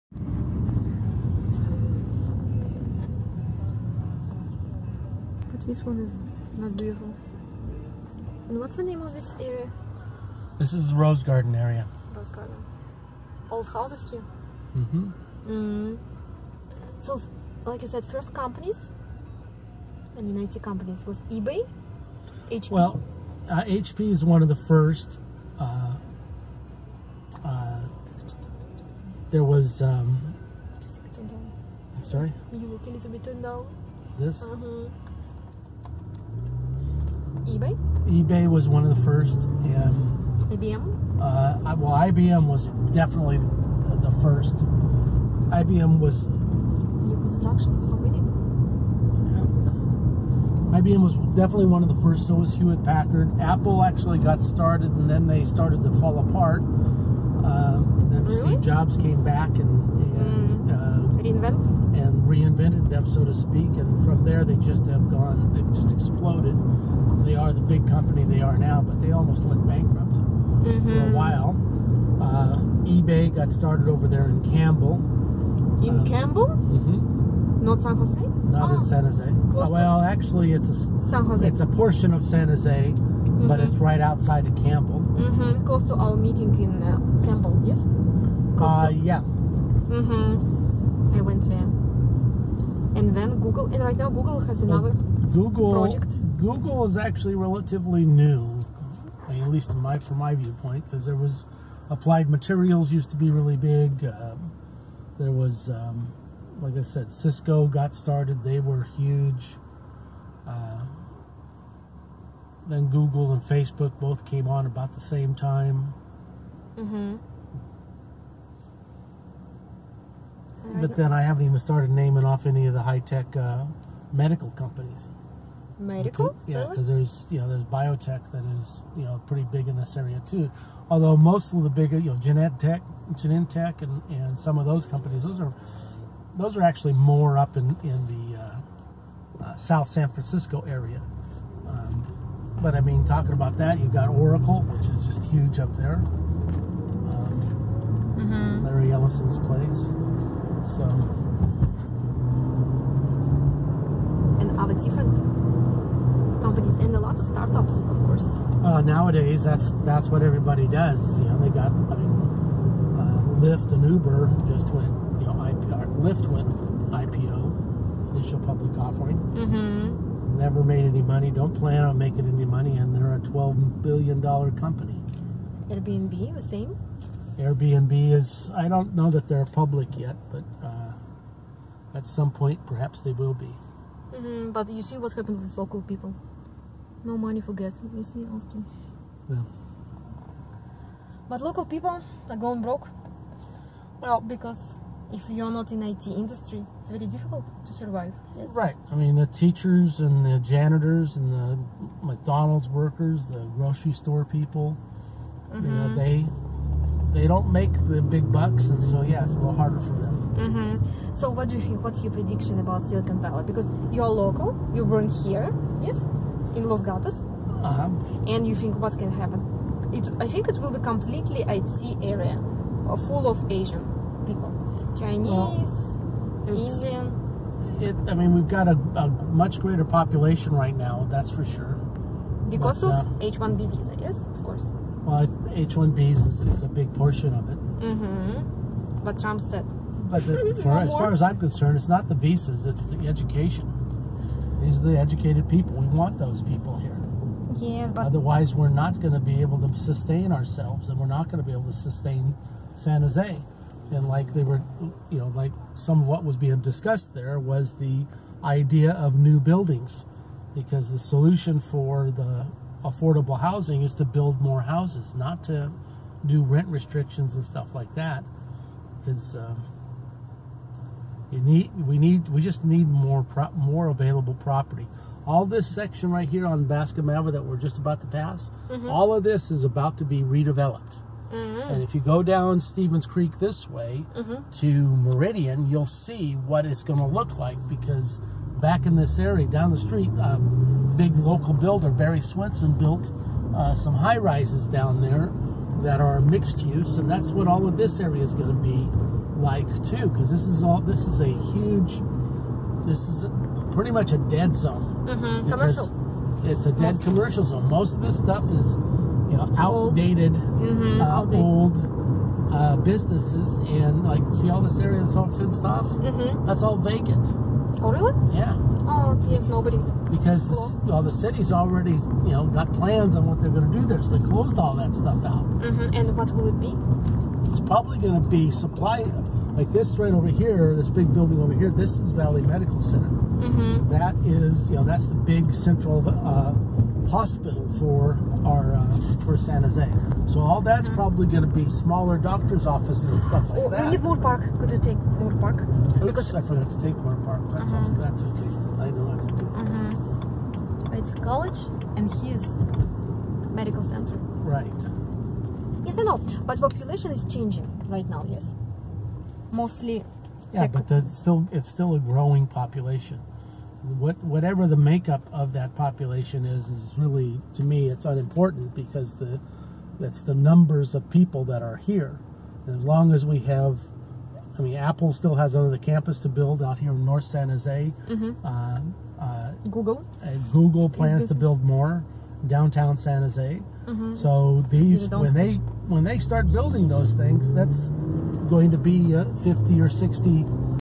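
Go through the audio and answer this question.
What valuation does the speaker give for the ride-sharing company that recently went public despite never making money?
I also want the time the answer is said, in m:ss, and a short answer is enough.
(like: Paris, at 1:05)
$12 billion, at 2:53.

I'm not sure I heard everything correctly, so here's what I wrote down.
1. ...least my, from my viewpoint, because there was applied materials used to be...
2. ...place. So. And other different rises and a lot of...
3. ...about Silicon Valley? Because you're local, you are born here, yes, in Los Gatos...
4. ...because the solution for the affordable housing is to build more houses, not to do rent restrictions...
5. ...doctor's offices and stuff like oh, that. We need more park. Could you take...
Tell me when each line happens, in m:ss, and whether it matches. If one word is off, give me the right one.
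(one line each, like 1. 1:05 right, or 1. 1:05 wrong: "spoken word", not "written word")
1. 1:39 right
2. 2:29 wrong: "companies", not "rises"
3. 3:32 right
4. 4:20 right
5. 5:42 right.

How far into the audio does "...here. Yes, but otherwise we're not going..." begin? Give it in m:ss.
4:06.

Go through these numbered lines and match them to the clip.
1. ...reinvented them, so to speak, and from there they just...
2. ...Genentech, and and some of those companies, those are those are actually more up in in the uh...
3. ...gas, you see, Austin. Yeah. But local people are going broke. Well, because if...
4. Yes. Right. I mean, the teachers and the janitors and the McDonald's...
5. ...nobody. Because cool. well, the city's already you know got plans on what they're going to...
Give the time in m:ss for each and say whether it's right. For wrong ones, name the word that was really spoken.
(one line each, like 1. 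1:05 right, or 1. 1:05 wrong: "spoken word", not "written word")
1. 1:02 right
2. 2:13 right
3. 3:07 right
4. 3:18 right
5. 5:19 right.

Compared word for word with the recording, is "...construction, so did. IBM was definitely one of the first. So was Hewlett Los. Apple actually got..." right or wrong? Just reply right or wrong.
wrong.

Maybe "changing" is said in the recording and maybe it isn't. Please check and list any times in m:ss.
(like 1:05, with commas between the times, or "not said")
5:57.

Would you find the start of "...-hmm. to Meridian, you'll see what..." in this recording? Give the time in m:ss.
4:44.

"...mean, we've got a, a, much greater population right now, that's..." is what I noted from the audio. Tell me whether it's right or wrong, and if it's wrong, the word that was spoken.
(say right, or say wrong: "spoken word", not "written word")
right.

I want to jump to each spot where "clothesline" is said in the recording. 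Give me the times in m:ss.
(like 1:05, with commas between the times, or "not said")
not said.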